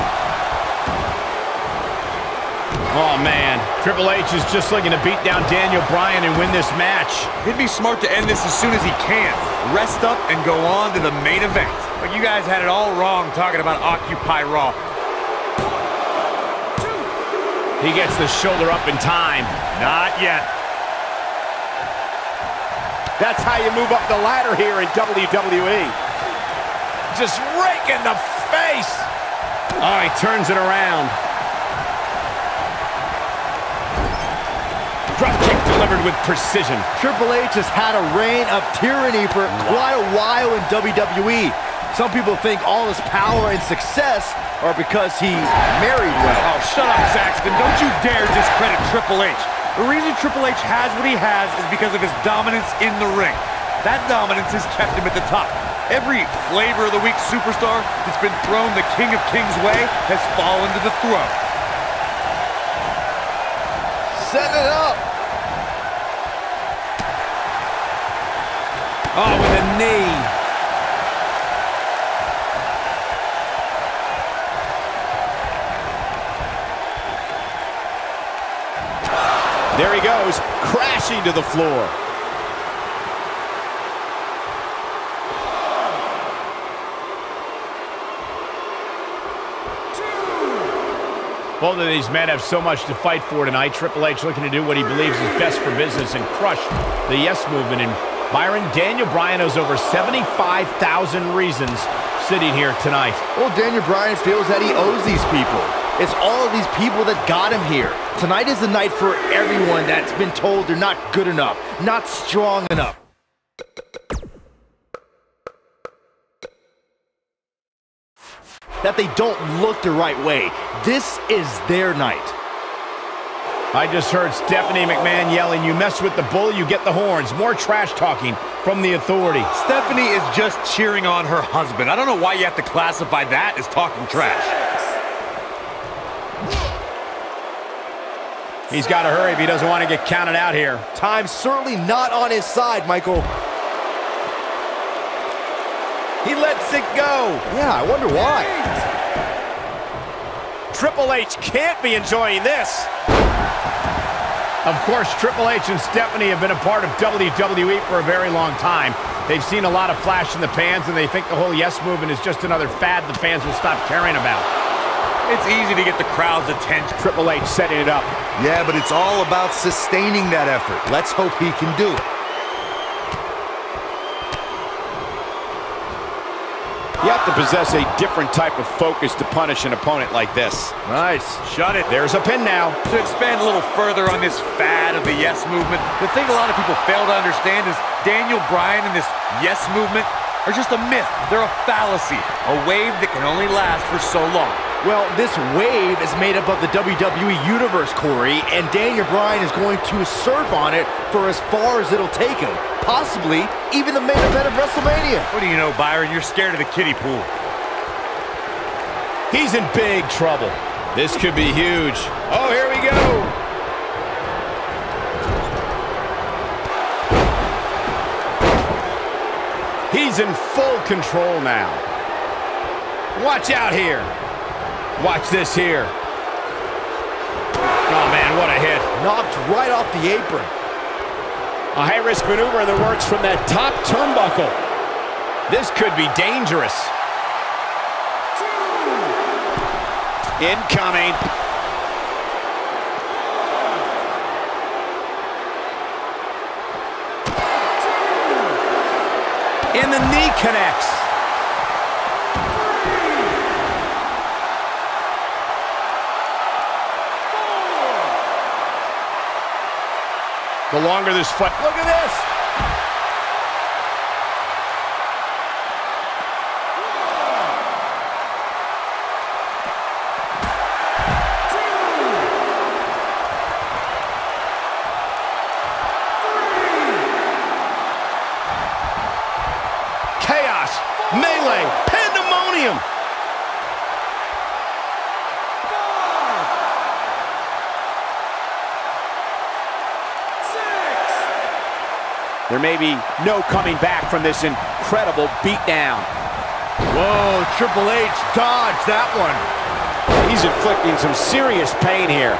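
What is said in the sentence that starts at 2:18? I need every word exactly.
He's got to hurry if he doesn't want to get counted out here.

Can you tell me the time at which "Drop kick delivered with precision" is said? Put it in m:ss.
0:35.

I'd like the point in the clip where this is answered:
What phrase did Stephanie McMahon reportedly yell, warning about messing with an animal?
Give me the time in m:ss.
2:06.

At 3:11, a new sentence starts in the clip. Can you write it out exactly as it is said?
They're a fallacy, a wave that can only last for so long.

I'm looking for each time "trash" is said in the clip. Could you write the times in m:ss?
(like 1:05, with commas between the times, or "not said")
2:07, 2:14.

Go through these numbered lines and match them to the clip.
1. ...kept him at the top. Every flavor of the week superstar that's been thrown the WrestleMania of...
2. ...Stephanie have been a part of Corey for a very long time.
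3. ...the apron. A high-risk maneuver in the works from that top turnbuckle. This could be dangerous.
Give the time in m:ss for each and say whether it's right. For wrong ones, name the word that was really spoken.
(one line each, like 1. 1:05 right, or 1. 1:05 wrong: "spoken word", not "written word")
1. 0:54 wrong: "King", not "WrestleMania"
2. 2:35 wrong: "WWE", not "Corey"
3. 3:49 right.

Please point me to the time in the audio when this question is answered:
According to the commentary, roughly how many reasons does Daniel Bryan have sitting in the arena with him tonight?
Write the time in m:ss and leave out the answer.
1:39.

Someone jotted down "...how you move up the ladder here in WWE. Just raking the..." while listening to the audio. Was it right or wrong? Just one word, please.
right.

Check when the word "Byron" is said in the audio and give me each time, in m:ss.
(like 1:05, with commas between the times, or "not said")
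1:38, 3:25.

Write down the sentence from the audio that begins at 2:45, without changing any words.
It's easy to get the crowd's attention.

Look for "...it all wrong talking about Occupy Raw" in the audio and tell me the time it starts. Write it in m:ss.
0:12.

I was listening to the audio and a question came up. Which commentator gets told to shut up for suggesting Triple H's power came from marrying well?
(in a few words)
Saxton.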